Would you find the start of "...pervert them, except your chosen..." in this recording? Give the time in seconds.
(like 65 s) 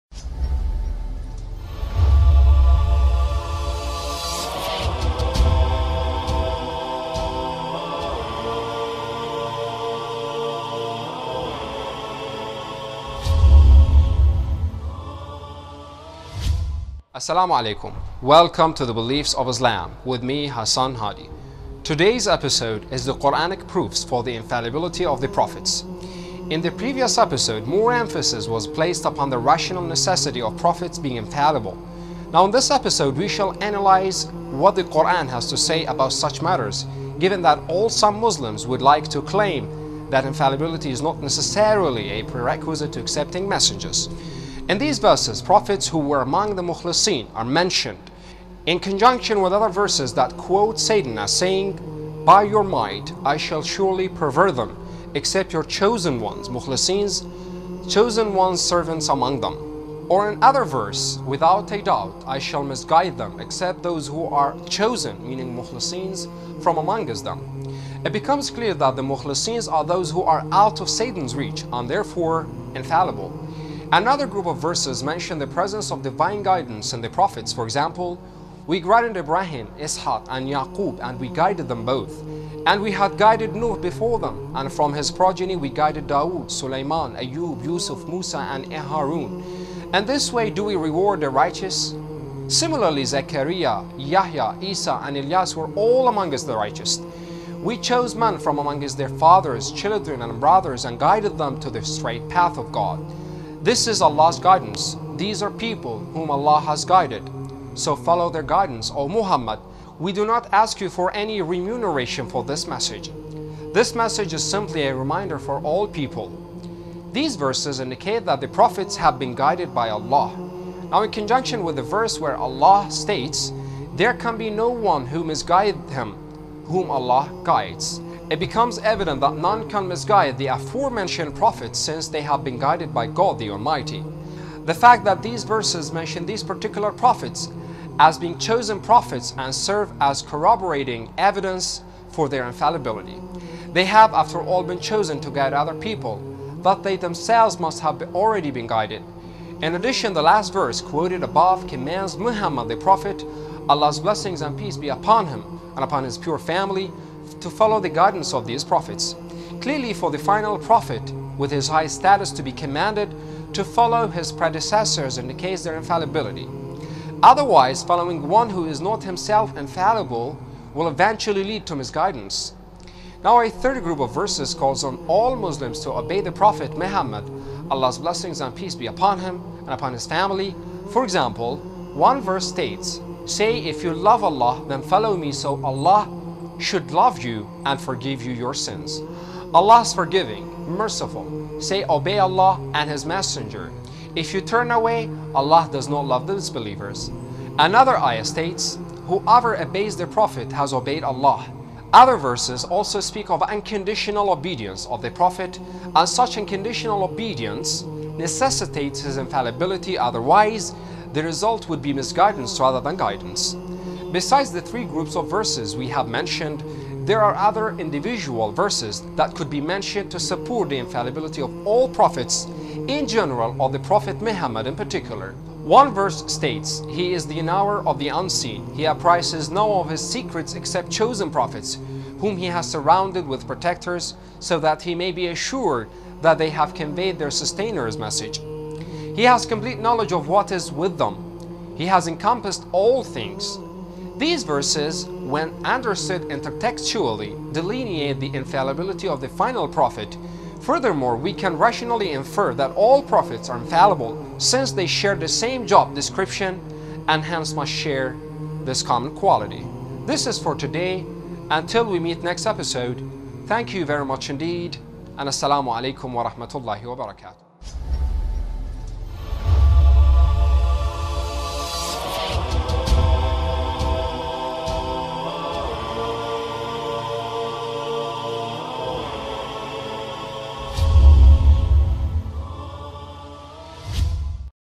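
54 s.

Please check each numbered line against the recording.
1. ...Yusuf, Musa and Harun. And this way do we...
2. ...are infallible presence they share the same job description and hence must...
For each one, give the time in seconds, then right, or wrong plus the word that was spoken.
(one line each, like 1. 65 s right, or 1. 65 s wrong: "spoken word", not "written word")
1. 87 s right
2. 253 s wrong: "since", not "presence".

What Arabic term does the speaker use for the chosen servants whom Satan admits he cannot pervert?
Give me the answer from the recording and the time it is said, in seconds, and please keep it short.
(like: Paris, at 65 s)
mukhlisin, at 46 s.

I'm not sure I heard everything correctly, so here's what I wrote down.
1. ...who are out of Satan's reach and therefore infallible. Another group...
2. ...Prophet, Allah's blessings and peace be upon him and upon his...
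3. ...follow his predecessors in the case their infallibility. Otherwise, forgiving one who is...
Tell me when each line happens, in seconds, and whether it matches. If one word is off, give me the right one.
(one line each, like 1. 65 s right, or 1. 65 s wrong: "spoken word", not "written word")
1. 70 s right
2. 152 s right
3. 163 s wrong: "following", not "forgiving".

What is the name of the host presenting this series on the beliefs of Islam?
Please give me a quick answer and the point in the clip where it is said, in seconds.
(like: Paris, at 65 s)
Hassan Hadi, at 20 s.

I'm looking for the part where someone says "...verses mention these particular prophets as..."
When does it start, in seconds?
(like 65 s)
135 s.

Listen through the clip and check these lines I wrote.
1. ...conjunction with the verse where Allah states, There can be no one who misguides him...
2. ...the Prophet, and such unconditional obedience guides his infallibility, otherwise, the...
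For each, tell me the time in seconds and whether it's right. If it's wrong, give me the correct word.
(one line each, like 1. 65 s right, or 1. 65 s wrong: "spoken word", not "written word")
1. 121 s right
2. 205 s wrong: "necessitates", not "guides".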